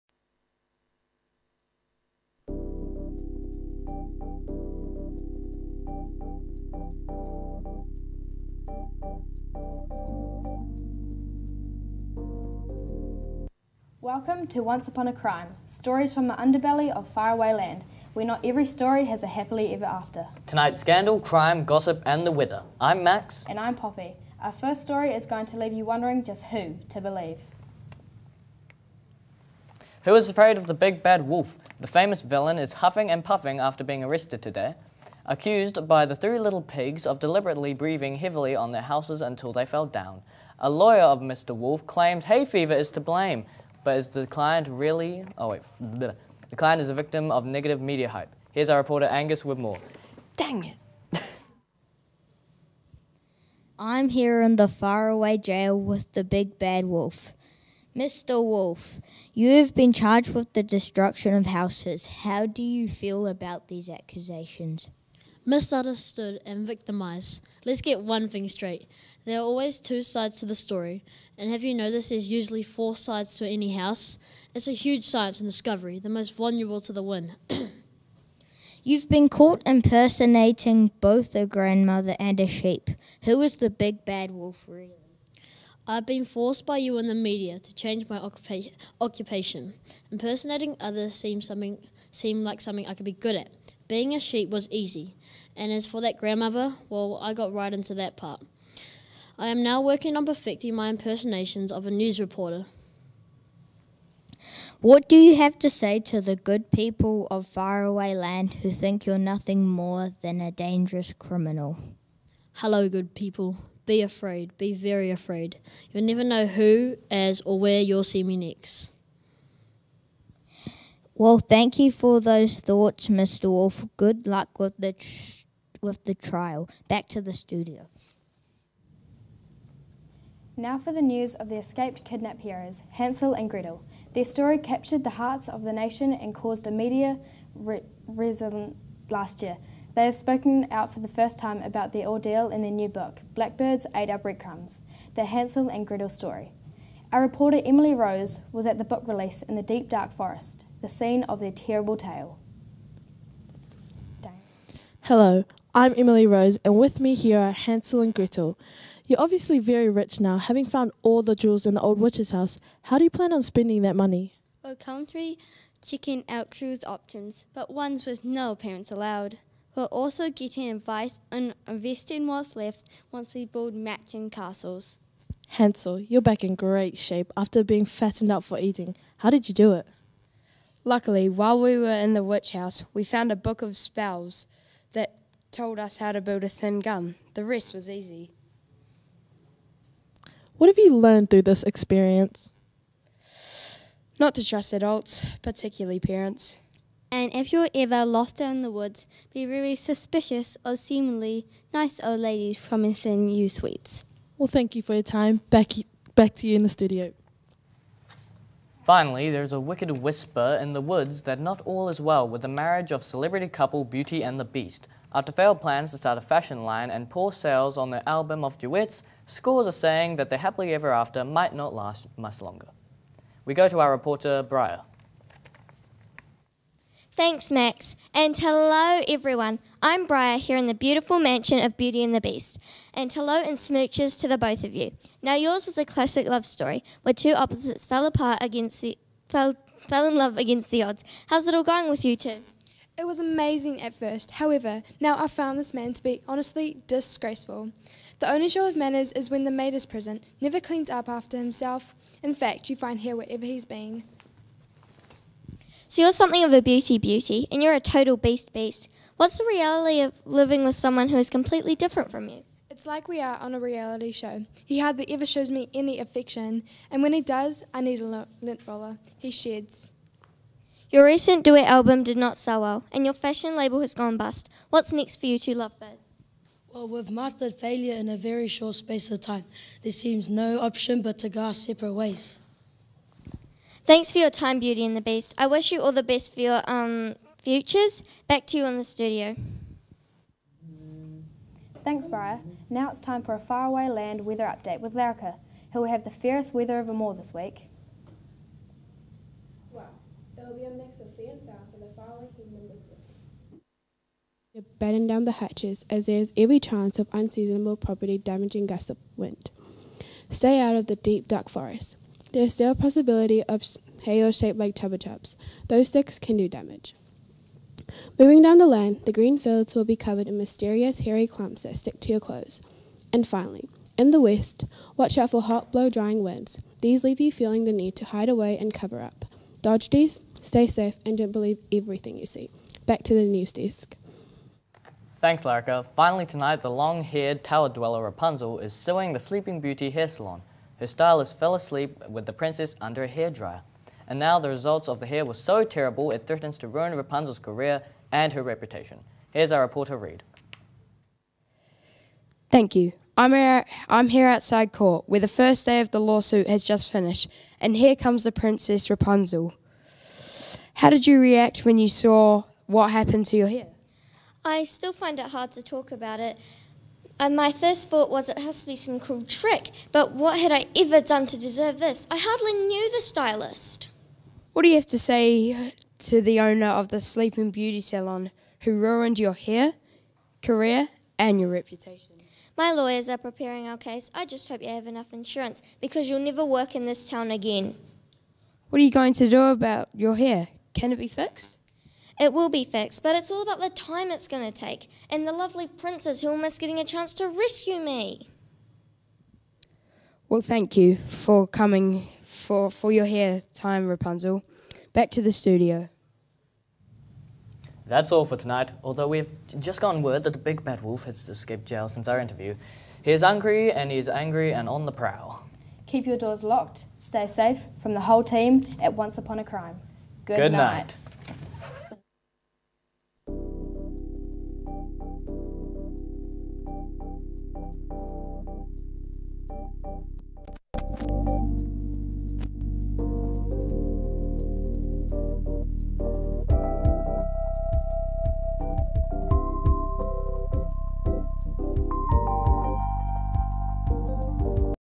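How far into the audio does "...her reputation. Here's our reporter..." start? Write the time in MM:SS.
05:48.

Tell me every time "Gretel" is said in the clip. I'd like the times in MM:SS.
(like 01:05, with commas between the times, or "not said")
02:13, 02:25, 02:38.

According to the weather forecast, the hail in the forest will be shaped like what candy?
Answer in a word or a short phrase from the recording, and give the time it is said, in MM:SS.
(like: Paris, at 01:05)
Chupa Chups, at 05:14.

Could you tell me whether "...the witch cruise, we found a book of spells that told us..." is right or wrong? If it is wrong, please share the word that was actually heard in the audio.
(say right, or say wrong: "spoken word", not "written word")
wrong: "house", not "cruise".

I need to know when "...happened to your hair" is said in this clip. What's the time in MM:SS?
06:02.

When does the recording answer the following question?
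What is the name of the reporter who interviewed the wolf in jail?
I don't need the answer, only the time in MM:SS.
00:49.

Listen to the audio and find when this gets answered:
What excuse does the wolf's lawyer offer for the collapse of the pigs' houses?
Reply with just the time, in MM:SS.
00:42.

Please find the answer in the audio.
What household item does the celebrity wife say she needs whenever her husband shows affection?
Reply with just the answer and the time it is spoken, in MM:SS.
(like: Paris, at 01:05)
A lint roller, at 04:28.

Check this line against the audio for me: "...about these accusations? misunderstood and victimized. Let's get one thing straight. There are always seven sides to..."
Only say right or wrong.
wrong.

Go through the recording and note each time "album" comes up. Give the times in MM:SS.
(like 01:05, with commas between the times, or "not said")
03:38, 04:31.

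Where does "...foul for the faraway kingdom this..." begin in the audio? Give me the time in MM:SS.
05:01.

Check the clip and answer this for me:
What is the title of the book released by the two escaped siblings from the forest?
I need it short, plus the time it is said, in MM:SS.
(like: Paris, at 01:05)
Blackbirds Ate Our Breadcrumbs, at 02:23.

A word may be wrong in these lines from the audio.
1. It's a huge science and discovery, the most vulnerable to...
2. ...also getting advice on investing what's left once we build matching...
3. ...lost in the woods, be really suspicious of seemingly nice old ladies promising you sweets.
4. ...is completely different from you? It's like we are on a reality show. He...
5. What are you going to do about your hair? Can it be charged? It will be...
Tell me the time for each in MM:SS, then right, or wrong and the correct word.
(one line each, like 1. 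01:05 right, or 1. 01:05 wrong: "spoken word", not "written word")
1. 01:14 right
2. 02:49 right
3. 03:18 right
4. 04:21 right
5. 06:28 wrong: "fixed", not "charged".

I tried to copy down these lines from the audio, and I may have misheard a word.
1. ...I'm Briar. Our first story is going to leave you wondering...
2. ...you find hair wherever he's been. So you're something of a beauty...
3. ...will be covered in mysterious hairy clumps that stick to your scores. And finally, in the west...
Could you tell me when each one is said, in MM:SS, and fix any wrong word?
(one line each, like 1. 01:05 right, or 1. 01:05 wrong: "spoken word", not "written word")
1. 00:23 wrong: "Poppy", not "Briar"
2. 04:12 right
3. 05:19 wrong: "clothes", not "scores".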